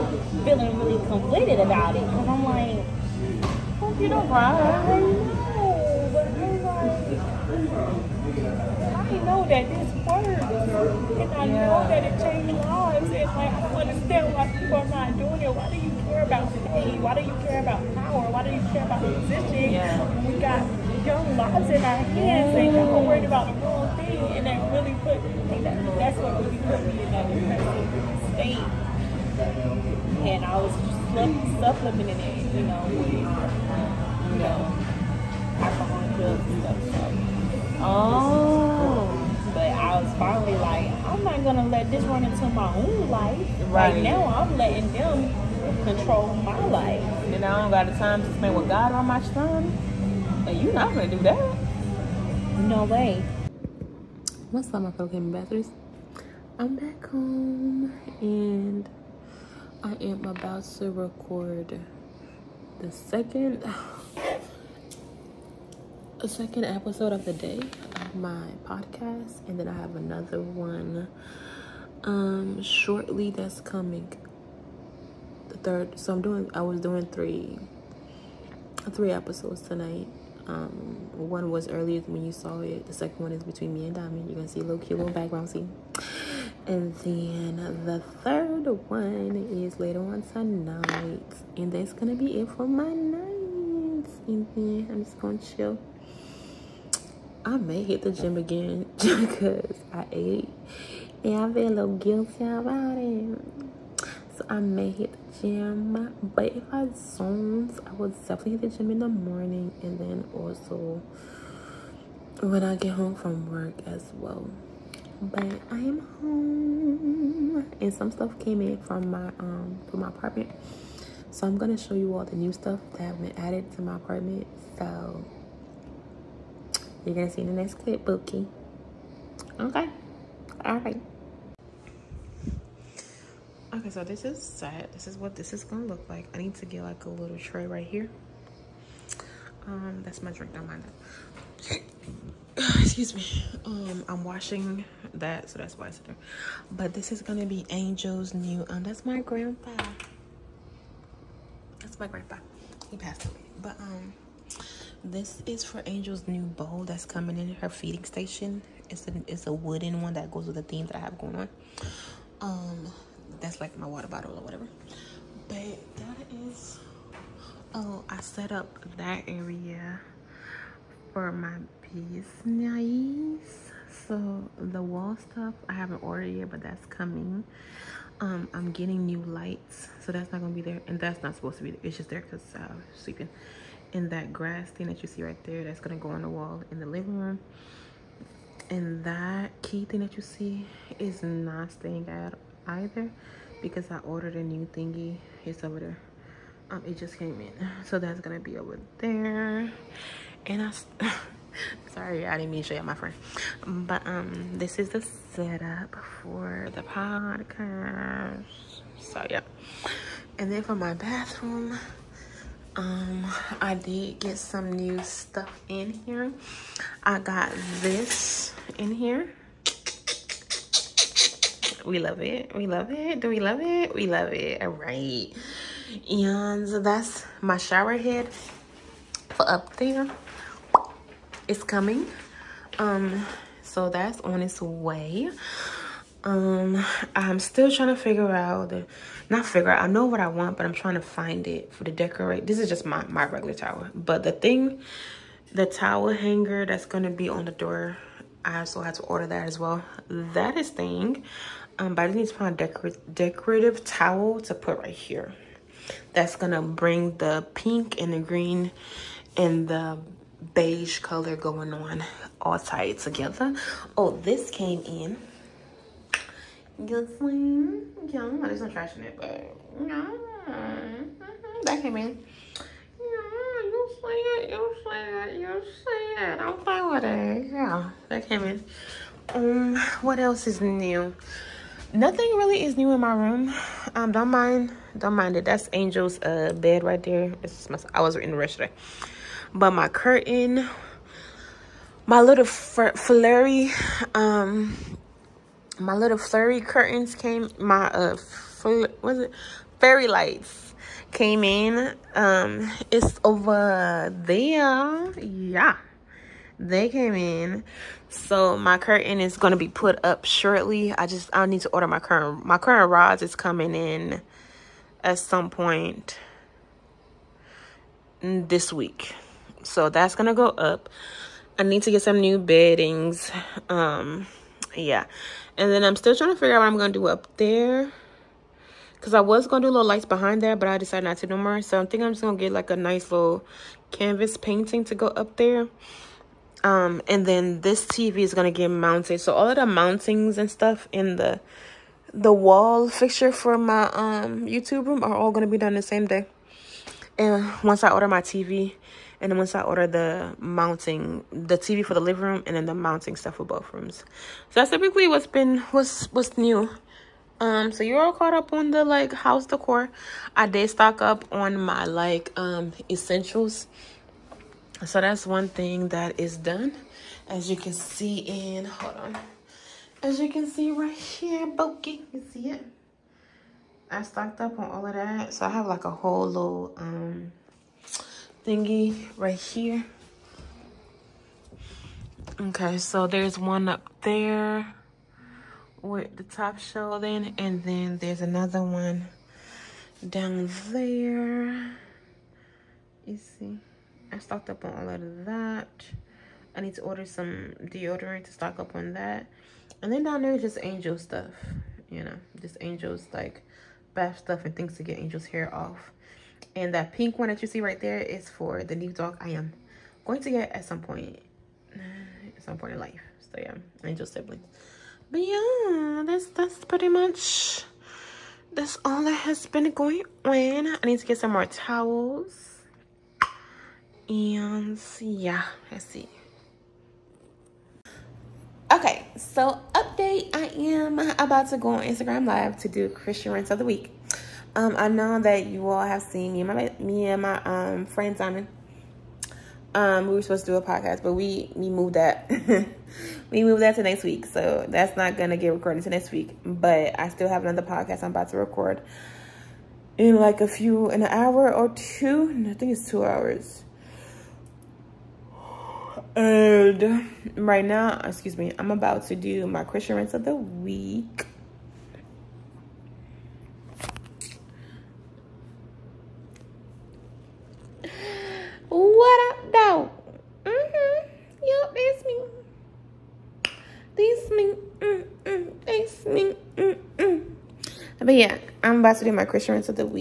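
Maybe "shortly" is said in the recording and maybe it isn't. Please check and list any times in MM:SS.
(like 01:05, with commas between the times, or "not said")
01:12, 05:10.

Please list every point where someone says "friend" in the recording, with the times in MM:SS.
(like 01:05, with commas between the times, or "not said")
03:22, 07:17.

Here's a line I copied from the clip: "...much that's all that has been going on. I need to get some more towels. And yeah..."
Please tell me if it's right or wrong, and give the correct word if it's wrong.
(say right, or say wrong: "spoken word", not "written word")
right.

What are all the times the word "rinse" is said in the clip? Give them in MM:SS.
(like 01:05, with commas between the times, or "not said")
07:13, 07:39.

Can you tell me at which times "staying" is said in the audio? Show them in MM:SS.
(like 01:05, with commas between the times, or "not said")
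03:11.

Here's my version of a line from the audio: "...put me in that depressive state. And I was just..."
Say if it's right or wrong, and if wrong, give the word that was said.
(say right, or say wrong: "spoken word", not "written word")
right.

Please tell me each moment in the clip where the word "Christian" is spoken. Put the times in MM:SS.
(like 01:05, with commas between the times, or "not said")
07:12, 07:39, 07:59.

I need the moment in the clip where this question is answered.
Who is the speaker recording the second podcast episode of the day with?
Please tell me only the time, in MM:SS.
01:23.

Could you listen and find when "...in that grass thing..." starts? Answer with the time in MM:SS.
03:03.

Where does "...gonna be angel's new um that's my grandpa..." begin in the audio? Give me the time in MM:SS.
02:27.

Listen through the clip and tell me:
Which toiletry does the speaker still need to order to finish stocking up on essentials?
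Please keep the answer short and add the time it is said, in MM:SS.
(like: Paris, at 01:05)
Deodorant, at 06:37.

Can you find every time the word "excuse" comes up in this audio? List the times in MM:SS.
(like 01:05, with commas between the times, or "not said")
02:22, 07:38.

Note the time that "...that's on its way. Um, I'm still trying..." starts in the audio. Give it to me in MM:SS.
03:53.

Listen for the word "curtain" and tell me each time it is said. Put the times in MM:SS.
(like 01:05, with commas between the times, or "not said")
04:49, 04:56, 05:08.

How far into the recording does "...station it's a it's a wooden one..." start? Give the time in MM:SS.
02:38.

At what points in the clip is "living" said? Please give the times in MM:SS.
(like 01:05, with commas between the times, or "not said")
03:06, 05:52.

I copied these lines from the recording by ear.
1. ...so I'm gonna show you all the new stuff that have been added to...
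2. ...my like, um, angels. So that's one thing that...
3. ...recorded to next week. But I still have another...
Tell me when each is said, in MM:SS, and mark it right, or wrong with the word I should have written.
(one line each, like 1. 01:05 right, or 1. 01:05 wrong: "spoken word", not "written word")
1. 02:01 right
2. 06:01 wrong: "essentials", not "angels"
3. 07:25 right.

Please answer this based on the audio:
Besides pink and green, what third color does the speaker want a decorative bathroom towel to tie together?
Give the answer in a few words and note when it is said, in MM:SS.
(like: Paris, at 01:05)
Beige, at 04:20.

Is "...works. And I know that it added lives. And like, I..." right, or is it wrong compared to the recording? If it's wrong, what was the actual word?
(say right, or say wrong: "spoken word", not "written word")
wrong: "changed", not "added".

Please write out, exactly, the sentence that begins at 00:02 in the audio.
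Because I'm like, hope you don't cry.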